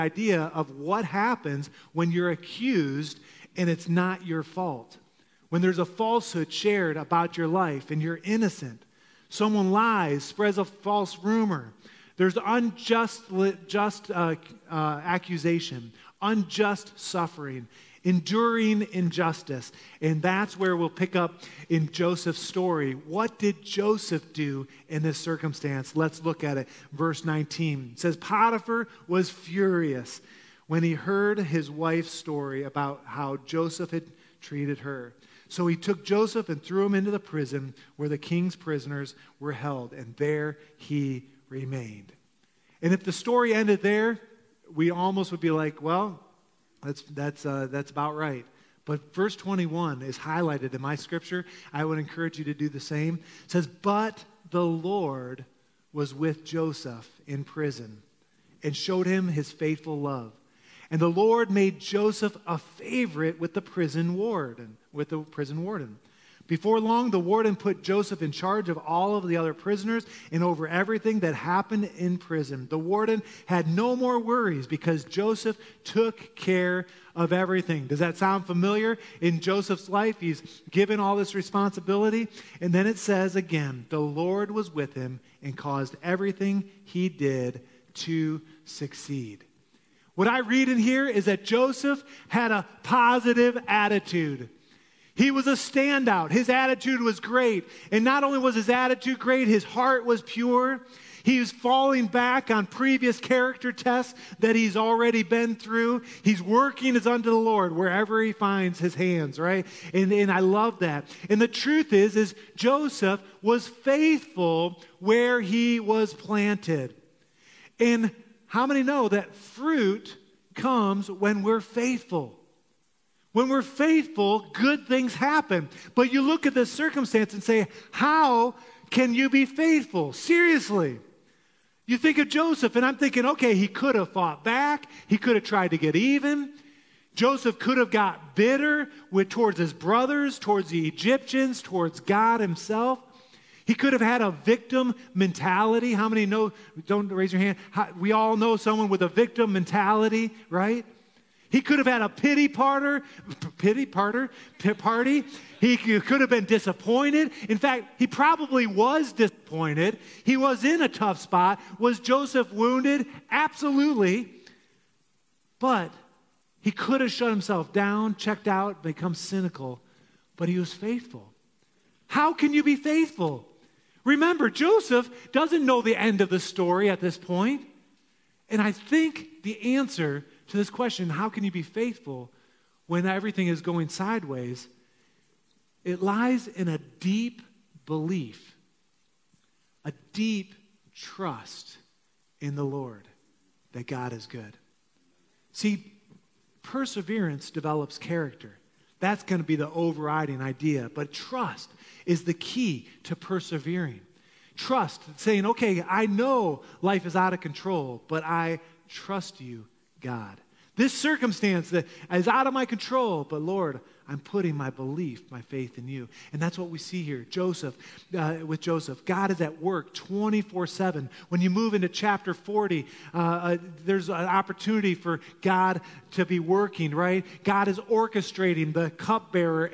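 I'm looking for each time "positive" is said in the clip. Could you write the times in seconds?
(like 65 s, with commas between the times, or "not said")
92 s.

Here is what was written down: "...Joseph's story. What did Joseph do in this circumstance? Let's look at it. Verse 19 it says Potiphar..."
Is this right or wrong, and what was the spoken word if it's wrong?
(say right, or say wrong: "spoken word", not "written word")
right.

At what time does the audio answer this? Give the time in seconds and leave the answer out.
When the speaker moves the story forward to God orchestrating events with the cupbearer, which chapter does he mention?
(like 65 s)
221 s.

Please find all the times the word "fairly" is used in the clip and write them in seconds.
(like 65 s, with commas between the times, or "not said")
not said.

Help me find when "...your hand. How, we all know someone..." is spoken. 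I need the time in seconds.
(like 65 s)
147 s.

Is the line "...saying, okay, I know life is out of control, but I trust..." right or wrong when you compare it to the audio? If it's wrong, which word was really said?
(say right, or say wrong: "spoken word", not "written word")
right.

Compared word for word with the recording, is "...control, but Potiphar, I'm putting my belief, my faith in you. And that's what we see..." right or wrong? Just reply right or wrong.
wrong.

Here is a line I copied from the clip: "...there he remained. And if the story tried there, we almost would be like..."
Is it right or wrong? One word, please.
wrong.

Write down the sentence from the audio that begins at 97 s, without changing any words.
And not only was his attitude great, his heart was pure.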